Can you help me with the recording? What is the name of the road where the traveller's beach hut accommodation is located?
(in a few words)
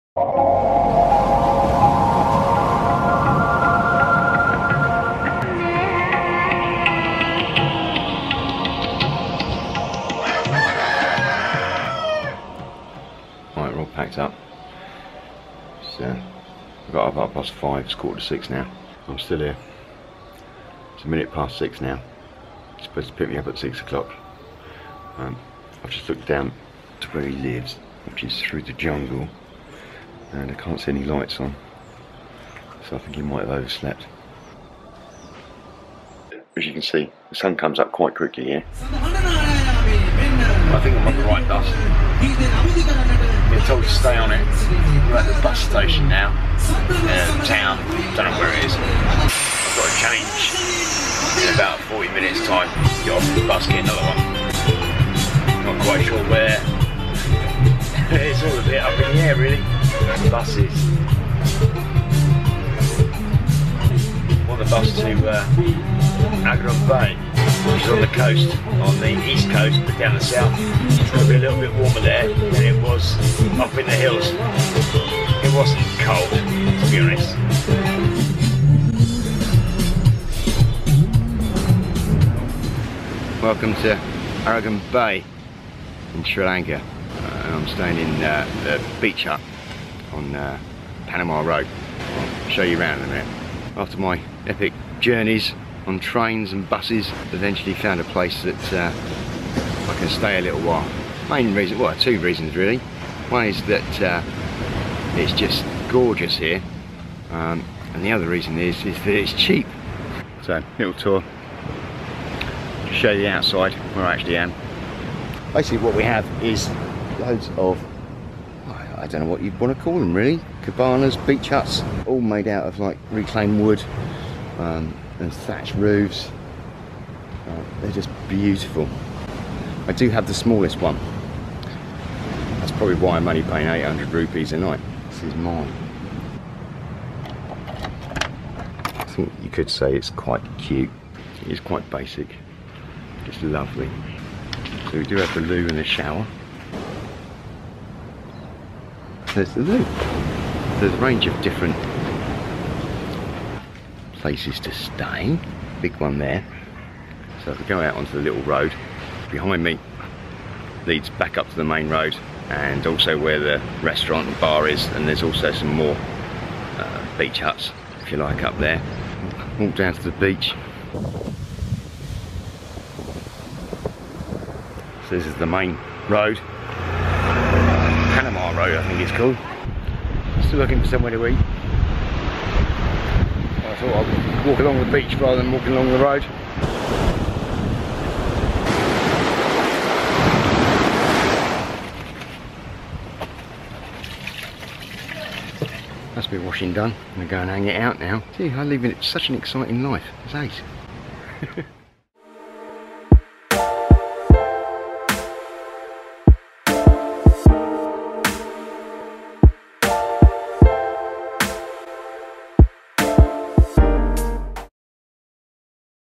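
Panama Road.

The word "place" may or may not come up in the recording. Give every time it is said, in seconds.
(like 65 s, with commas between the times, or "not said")
98 s, 154 s.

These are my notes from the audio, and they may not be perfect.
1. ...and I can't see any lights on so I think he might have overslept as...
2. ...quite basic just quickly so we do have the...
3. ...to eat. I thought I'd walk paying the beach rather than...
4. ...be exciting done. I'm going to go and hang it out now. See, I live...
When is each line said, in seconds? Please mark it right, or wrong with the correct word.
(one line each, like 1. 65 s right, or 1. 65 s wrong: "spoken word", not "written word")
1. 30 s right
2. 141 s wrong: "lovely", not "quickly"
3. 181 s wrong: "along", not "paying"
4. 196 s wrong: "washing", not "exciting".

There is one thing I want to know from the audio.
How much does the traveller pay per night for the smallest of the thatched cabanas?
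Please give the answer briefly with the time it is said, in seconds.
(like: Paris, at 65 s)
800 rupees, at 133 s.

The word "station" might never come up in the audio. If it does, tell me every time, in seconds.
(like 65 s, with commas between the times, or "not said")
45 s.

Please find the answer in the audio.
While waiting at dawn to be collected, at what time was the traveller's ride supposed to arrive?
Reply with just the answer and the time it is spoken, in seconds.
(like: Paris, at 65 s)
6 o'clock, at 23 s.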